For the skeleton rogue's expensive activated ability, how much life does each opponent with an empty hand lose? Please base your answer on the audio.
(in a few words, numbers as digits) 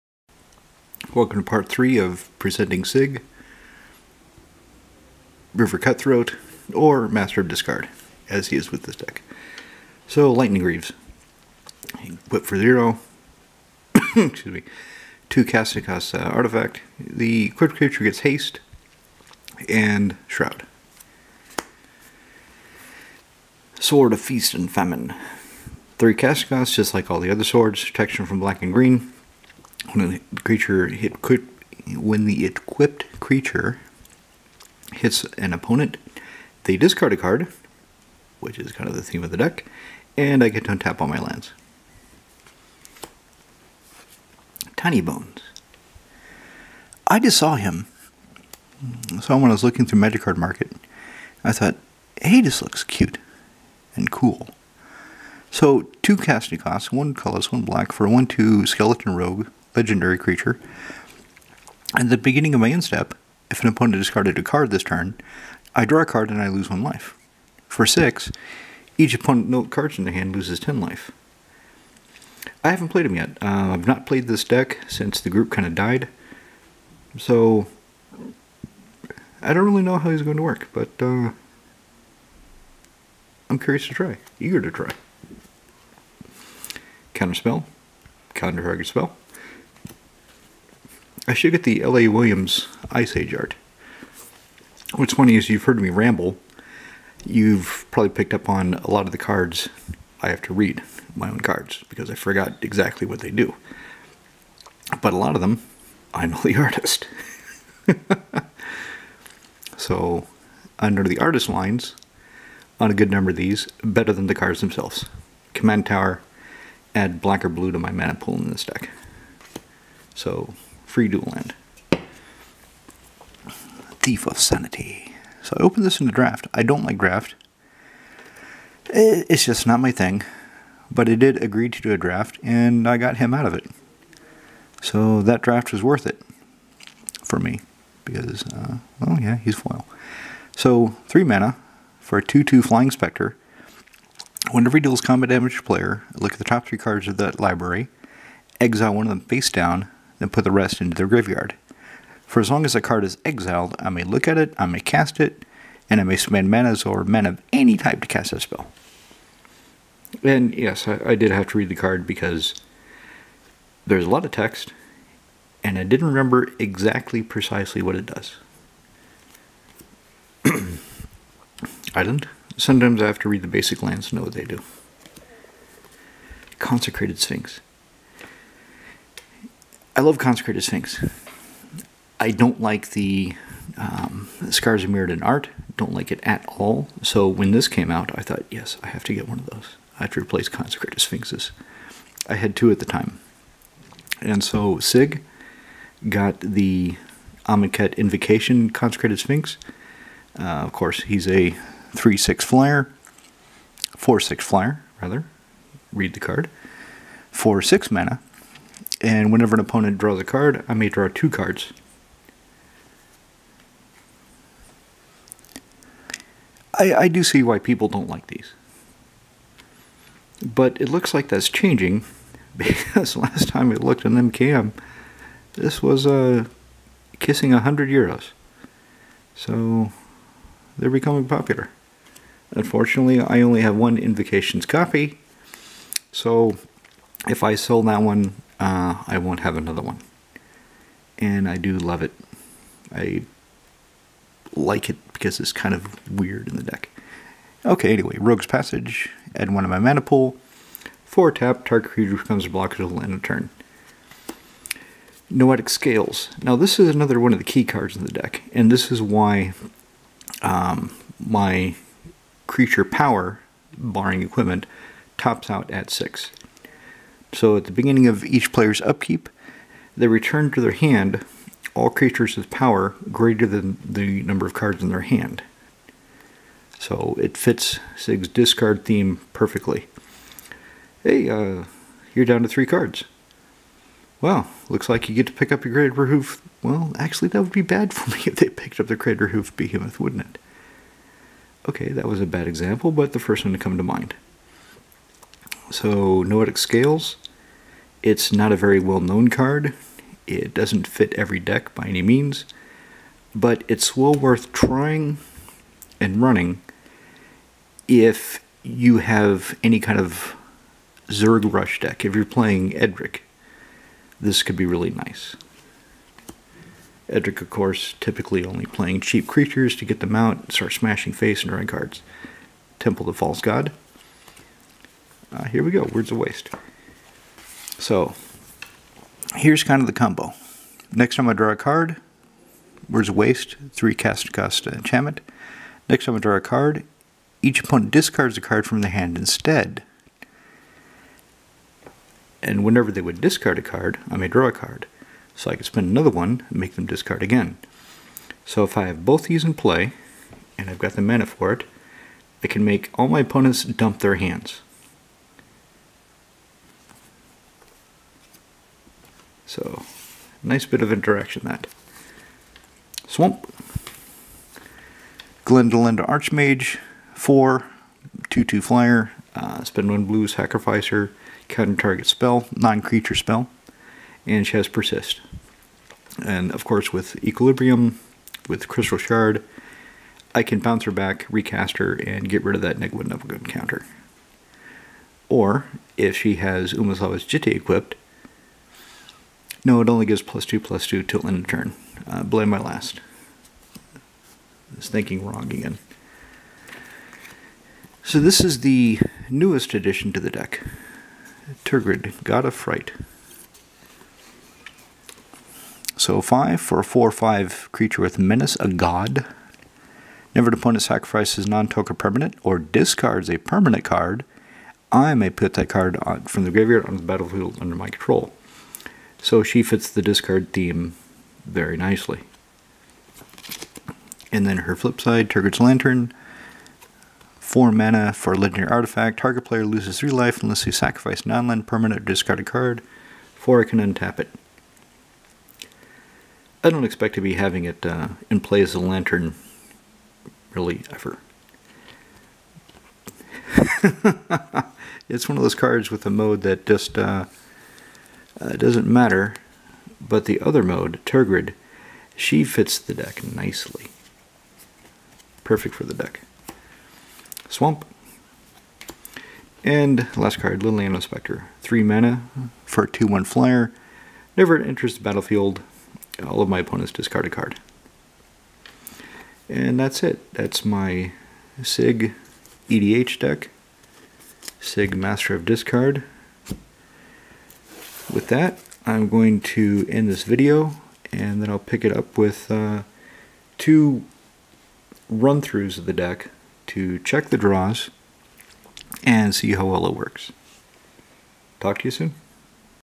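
10.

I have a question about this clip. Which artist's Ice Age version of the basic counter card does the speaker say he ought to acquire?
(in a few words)
L.A. Williams.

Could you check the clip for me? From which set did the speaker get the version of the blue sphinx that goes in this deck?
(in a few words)
Amonkhet Invocation.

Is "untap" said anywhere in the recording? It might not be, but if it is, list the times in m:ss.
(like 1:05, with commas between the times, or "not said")
0:40, 7:13.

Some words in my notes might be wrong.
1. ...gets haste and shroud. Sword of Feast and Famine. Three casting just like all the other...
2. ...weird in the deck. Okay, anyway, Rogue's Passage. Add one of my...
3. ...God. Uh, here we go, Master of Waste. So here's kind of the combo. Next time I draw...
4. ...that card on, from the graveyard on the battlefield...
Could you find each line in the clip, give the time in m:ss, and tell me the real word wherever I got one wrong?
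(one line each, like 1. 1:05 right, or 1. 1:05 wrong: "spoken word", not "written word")
1. 0:18 right
2. 4:06 right
3. 5:23 wrong: "Words", not "Master"
4. 6:55 right.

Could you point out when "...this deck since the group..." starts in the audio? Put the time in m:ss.
1:14.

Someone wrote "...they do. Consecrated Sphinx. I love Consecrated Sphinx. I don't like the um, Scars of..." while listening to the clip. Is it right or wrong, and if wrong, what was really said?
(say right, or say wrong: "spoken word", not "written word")
right.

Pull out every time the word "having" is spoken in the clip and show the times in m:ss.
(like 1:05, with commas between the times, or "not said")
7:17.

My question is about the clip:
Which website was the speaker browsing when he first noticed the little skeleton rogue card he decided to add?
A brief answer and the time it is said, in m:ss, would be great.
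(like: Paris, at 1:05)
Magic Card Market, at 0:49.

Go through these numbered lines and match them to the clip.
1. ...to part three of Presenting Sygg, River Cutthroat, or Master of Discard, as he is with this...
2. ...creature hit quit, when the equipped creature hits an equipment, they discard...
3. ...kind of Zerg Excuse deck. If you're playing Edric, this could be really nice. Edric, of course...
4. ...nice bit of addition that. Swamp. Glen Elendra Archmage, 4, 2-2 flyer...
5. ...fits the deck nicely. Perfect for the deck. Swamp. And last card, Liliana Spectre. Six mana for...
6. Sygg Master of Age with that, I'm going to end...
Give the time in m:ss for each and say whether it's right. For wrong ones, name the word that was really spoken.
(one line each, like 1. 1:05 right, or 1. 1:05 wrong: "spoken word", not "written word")
1. 0:01 right
2. 0:30 wrong: "opponent", not "equipment"
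3. 5:09 wrong: "Rush", not "Excuse"
4. 6:00 wrong: "interaction", not "addition"
5. 7:32 wrong: "Three", not "Six"
6. 7:54 wrong: "Discard", not "Age".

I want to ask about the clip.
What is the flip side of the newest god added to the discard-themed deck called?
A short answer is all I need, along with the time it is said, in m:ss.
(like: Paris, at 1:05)
Tergrid's Lantern, at 7:05.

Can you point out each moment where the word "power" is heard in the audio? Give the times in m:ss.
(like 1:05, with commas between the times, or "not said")
4:22, 4:32.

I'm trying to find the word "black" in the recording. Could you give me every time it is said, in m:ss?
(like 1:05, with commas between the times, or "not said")
0:28, 0:57, 1:57.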